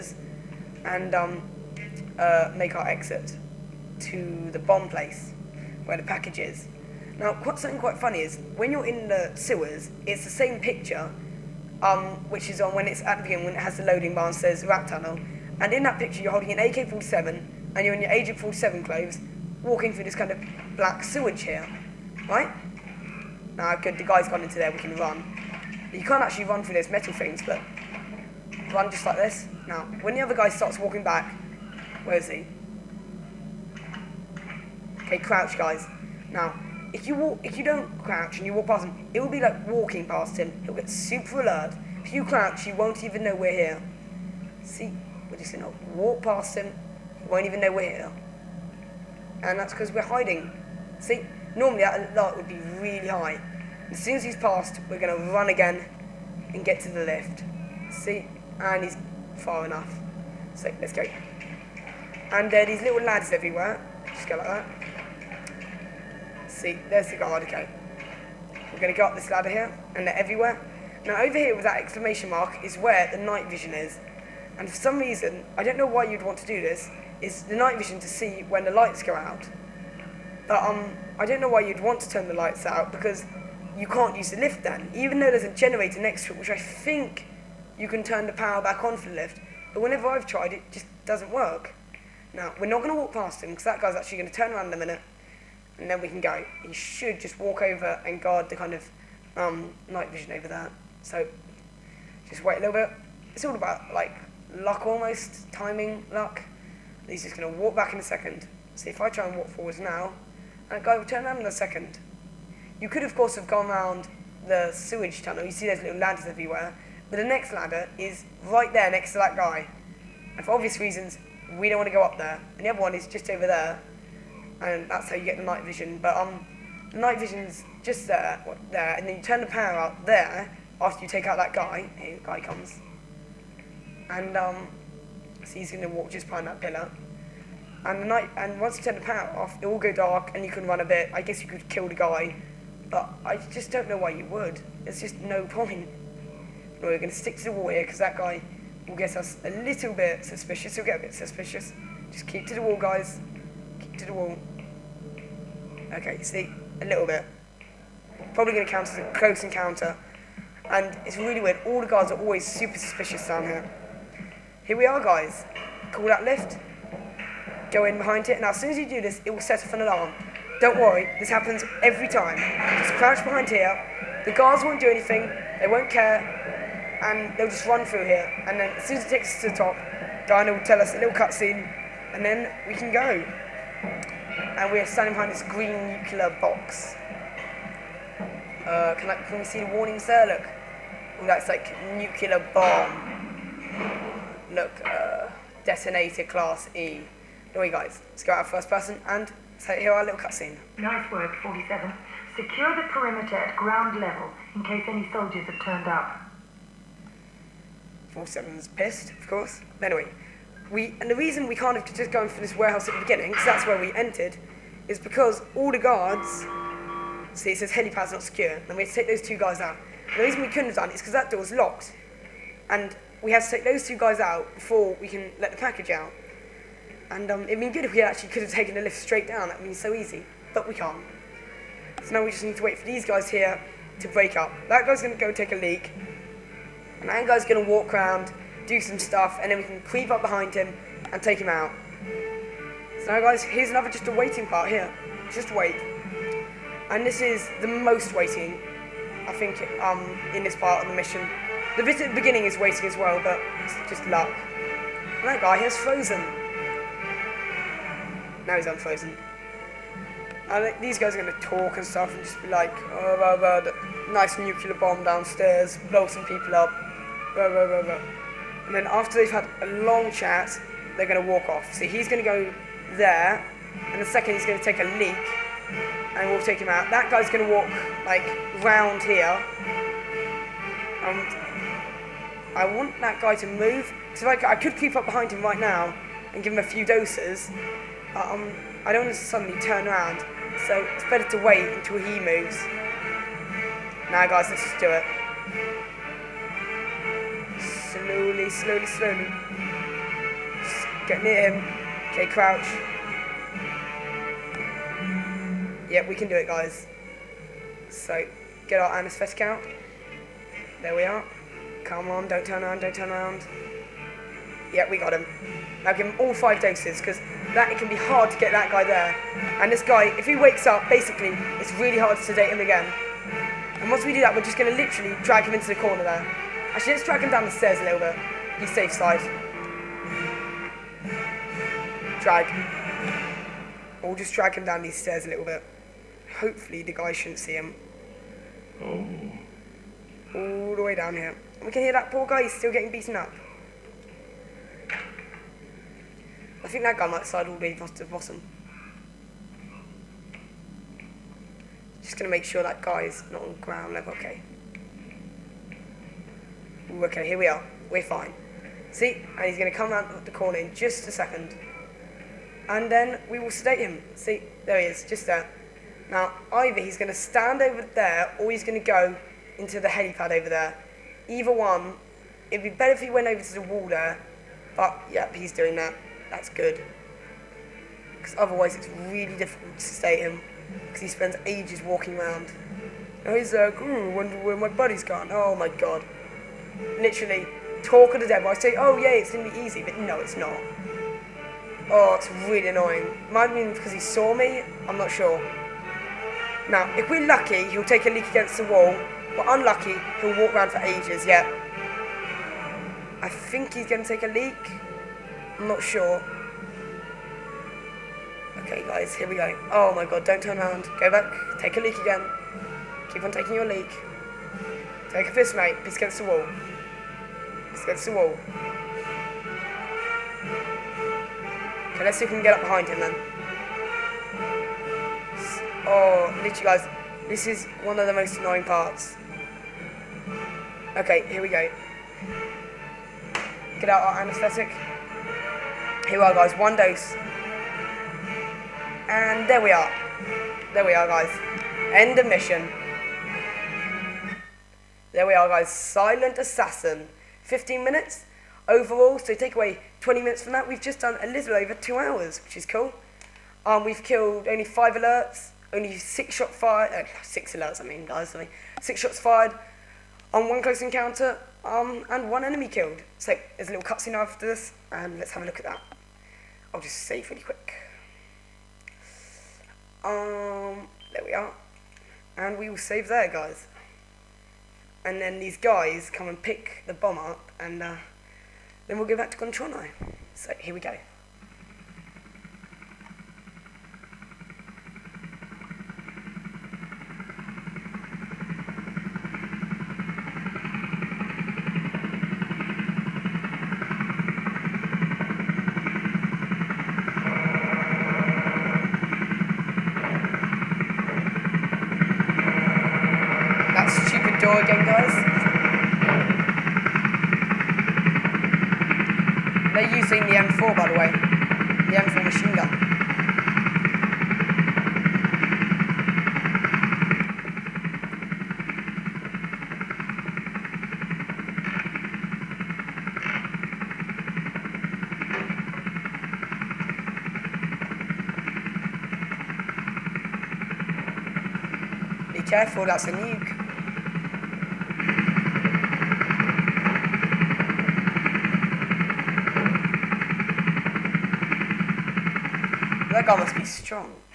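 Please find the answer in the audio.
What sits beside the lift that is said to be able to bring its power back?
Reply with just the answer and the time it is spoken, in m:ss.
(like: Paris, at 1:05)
A generator, at 1:25.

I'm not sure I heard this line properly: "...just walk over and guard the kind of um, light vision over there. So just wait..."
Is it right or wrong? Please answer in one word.
wrong.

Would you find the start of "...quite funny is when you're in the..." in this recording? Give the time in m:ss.
0:07.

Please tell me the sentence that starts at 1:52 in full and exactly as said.
You could, of course, have gone round the sewage tunnel.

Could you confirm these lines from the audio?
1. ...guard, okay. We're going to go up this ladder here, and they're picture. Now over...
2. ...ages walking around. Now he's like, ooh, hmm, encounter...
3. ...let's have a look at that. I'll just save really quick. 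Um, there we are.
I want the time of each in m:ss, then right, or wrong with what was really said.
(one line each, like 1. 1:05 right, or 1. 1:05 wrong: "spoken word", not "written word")
1. 1:07 wrong: "everywhere", not "picture"
2. 6:21 wrong: "wonder", not "encounter"
3. 7:45 right.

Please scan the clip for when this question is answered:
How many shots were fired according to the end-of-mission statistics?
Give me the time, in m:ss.
7:38.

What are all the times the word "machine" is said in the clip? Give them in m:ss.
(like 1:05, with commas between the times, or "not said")
8:32.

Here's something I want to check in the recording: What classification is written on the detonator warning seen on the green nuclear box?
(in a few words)
Class E.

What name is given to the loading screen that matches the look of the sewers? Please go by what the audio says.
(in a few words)
Rat tunnel.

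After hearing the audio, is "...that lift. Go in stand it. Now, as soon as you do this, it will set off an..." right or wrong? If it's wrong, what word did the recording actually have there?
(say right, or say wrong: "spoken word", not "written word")
wrong: "behind", not "stand".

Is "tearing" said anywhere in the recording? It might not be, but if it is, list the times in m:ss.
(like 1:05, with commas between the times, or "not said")
not said.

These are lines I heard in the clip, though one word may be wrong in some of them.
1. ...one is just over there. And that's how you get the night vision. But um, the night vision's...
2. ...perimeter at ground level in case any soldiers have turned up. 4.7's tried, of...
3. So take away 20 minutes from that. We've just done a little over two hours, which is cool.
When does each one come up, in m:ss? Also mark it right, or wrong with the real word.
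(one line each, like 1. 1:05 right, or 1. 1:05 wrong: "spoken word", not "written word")
1. 2:02 right
2. 3:22 wrong: "pissed", not "tried"
3. 7:29 right.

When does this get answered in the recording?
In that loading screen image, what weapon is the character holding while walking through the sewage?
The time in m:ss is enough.
0:16.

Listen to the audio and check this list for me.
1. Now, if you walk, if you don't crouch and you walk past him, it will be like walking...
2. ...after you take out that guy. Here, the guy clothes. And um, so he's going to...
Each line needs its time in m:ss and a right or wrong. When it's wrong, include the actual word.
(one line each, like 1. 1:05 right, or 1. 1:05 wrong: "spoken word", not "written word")
1. 0:36 right
2. 2:10 wrong: "comes", not "clothes".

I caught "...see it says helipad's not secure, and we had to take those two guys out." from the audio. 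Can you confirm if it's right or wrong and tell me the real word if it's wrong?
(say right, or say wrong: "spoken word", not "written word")
right.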